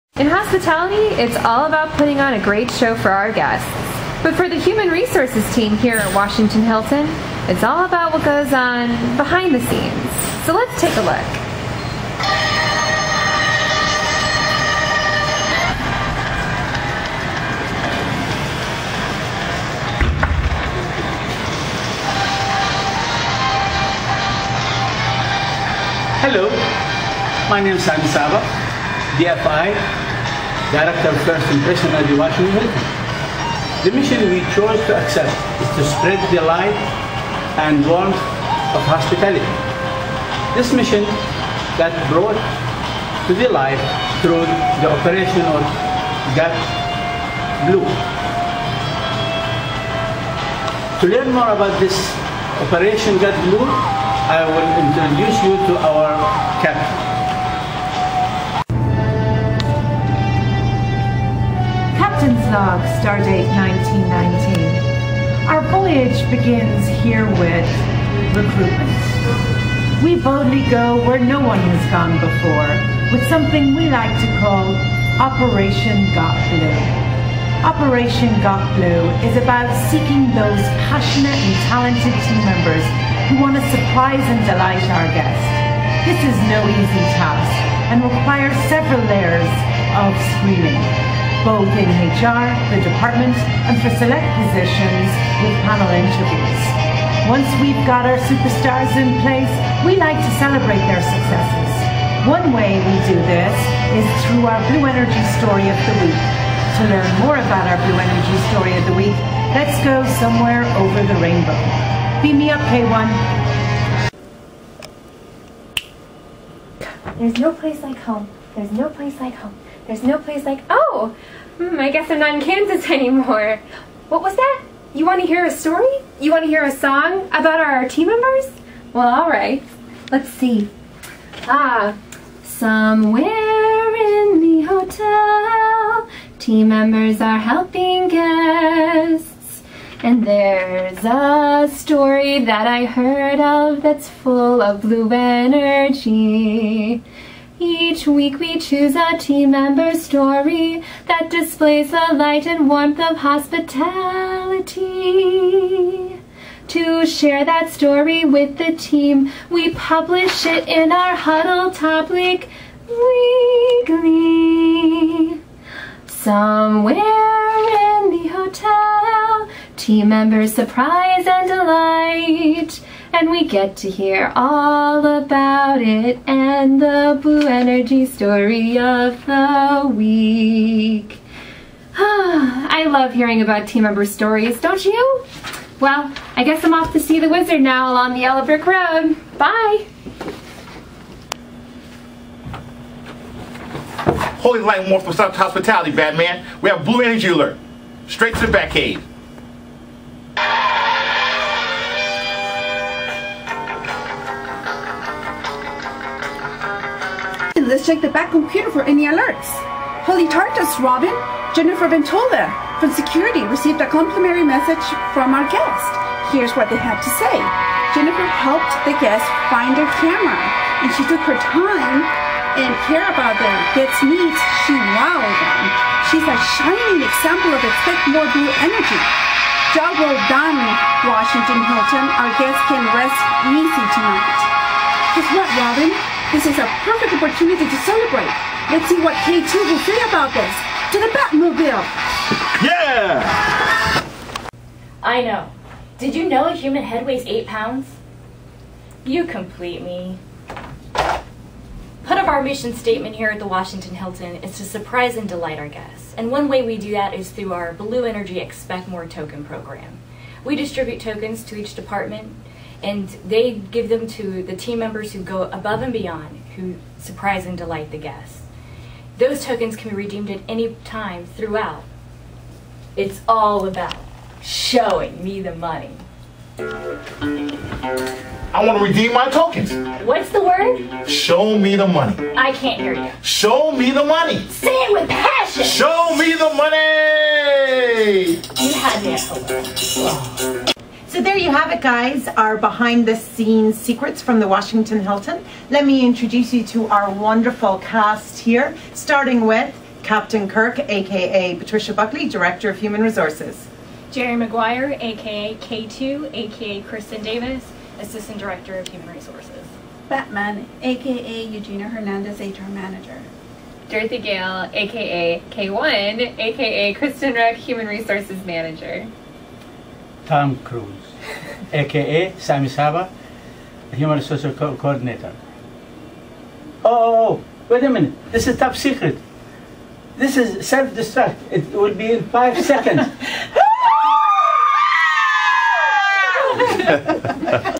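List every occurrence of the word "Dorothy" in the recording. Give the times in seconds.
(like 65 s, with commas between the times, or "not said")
313 s.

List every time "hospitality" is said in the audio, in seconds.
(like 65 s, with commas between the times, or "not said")
0 s, 38 s, 153 s, 195 s.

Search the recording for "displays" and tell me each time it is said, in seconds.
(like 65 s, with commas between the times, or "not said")
151 s.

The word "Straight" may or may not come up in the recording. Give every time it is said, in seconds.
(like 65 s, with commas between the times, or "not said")
198 s.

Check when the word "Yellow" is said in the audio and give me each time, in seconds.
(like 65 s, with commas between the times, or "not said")
188 s.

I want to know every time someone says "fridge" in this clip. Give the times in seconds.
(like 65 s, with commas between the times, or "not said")
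not said.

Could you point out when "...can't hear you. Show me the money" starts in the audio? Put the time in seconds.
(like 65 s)
282 s.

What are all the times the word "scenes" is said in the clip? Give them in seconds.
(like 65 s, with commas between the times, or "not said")
9 s, 293 s.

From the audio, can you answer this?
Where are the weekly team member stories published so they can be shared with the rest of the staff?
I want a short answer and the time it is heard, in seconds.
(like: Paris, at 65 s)
Huddle topic Weekly, at 161 s.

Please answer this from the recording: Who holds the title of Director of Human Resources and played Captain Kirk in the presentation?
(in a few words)
Patricia Buckley.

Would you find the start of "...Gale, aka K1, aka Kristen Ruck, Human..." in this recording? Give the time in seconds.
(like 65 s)
314 s.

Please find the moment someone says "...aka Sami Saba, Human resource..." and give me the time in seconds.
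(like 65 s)
321 s.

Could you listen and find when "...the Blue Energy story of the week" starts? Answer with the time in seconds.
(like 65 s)
176 s.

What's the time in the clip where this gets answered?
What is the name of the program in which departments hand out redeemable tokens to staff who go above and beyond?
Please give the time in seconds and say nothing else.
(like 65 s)
257 s.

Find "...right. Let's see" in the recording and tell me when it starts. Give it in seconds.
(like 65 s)
129 s.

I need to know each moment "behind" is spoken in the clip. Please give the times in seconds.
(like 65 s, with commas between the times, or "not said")
9 s, 292 s.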